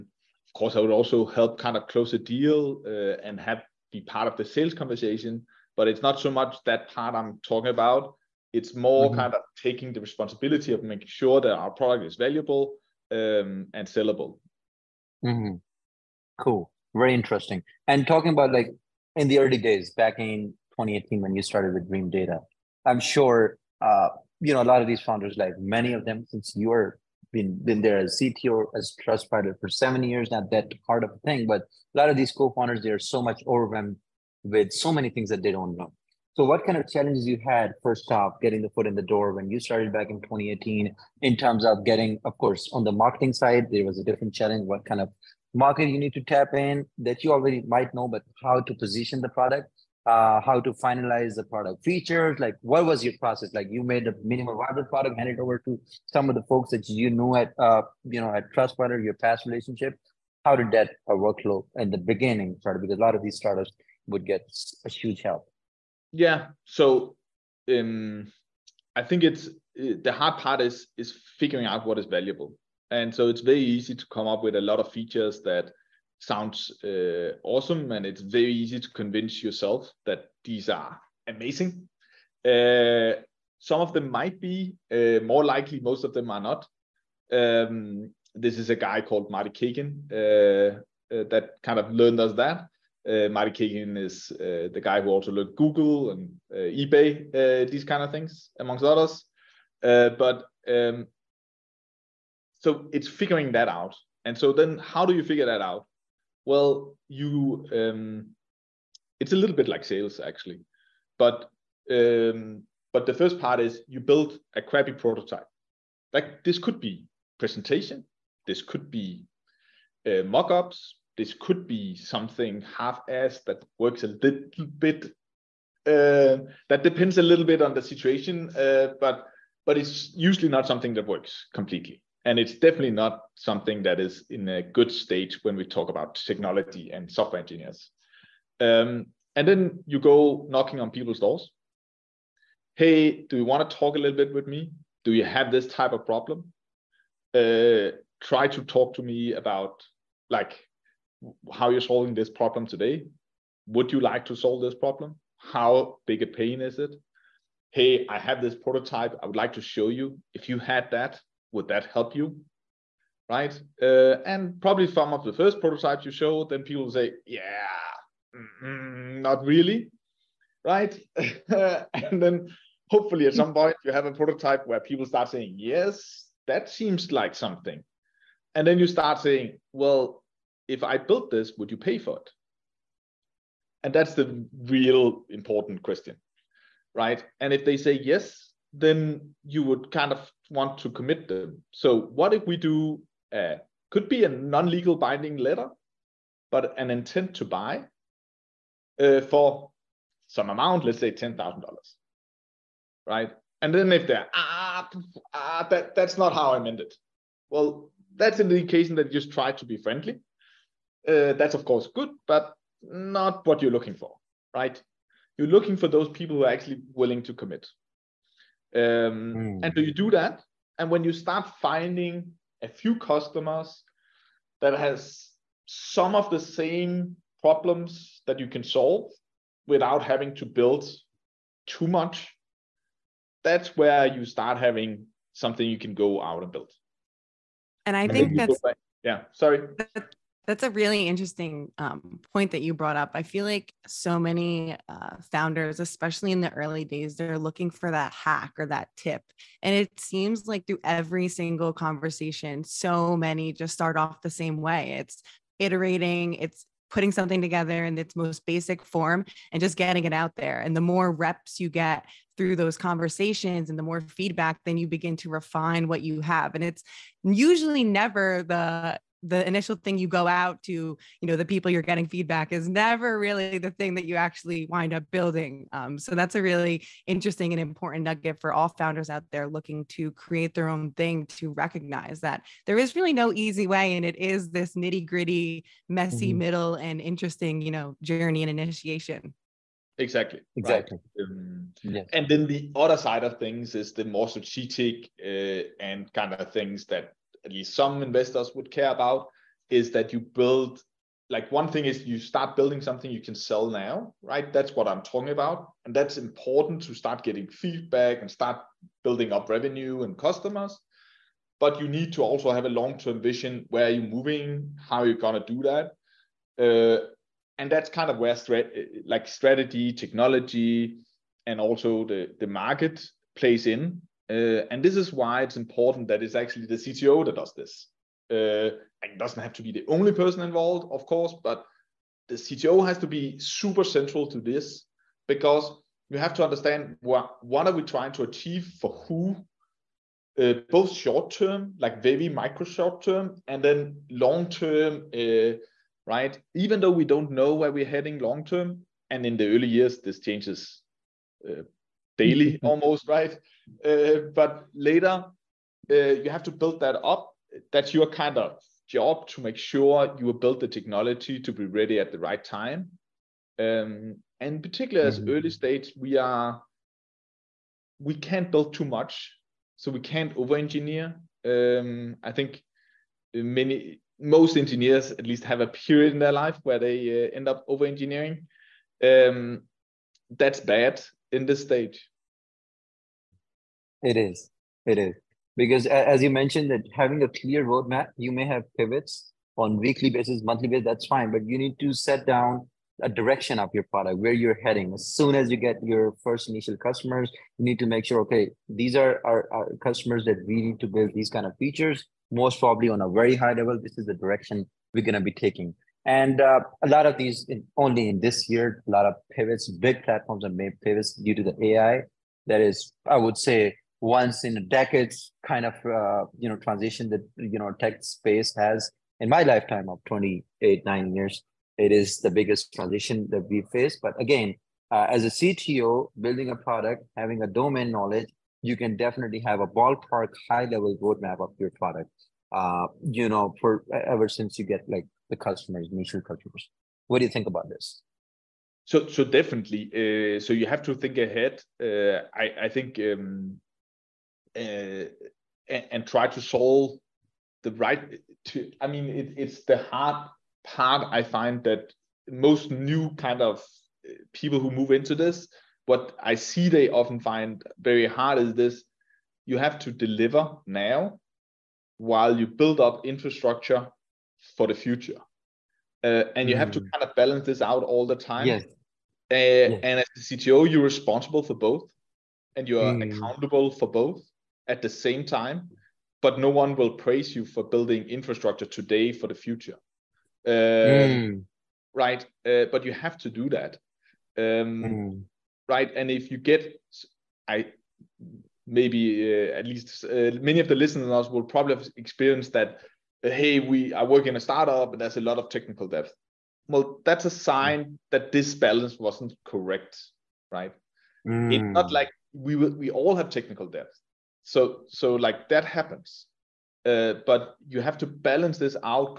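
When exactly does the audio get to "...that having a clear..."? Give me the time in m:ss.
6:26.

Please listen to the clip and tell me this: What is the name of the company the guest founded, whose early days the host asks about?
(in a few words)
Dreamdata.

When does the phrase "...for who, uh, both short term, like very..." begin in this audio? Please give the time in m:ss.
5:38.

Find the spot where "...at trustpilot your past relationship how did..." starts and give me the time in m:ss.
0:58.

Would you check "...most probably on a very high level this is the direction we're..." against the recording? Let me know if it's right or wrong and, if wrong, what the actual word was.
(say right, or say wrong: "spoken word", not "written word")
right.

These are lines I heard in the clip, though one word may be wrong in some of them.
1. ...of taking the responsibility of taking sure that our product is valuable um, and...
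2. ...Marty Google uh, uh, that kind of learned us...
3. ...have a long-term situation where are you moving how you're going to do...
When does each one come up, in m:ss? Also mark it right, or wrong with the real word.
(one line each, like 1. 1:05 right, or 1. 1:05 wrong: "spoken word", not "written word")
1. 0:09 wrong: "making", not "taking"
2. 1:29 wrong: "Cagan", not "Google"
3. 5:12 wrong: "vision", not "situation".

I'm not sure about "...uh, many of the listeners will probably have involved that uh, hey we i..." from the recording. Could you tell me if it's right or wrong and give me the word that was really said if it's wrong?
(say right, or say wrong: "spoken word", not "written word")
wrong: "experienced", not "involved".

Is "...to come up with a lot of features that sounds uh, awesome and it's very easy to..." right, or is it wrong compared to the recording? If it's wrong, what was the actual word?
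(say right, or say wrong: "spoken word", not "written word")
right.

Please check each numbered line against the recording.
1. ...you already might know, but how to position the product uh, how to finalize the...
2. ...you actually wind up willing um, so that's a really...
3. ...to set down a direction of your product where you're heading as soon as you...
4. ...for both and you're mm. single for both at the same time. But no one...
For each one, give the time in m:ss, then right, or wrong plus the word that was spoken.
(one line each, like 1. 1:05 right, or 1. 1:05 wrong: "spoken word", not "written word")
1. 0:47 right
2. 4:34 wrong: "building", not "willing"
3. 6:31 right
4. 7:51 wrong: "accountable", not "single".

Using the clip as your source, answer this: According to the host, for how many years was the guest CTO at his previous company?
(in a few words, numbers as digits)
7.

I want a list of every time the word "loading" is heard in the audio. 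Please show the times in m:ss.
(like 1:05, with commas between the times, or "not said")
not said.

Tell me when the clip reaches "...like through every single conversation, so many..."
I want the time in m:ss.
4:10.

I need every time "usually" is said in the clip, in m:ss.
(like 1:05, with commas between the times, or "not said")
2:10, 4:27.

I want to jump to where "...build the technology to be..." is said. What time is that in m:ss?
6:00.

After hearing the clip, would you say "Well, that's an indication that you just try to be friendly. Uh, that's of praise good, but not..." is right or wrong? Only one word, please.
wrong.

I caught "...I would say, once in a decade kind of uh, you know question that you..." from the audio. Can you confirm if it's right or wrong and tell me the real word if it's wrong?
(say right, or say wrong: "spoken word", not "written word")
wrong: "transition", not "question".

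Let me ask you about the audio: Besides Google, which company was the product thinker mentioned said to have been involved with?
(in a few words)
eBay.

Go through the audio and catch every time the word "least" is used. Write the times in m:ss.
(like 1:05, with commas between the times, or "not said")
4:57, 6:15, 8:09.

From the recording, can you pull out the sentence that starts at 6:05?
early stage, we are we can't build too much, so we can't over-engineer.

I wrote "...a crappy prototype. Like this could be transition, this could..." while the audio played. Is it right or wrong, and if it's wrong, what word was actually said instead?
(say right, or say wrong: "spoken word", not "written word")
wrong: "presentation", not "transition".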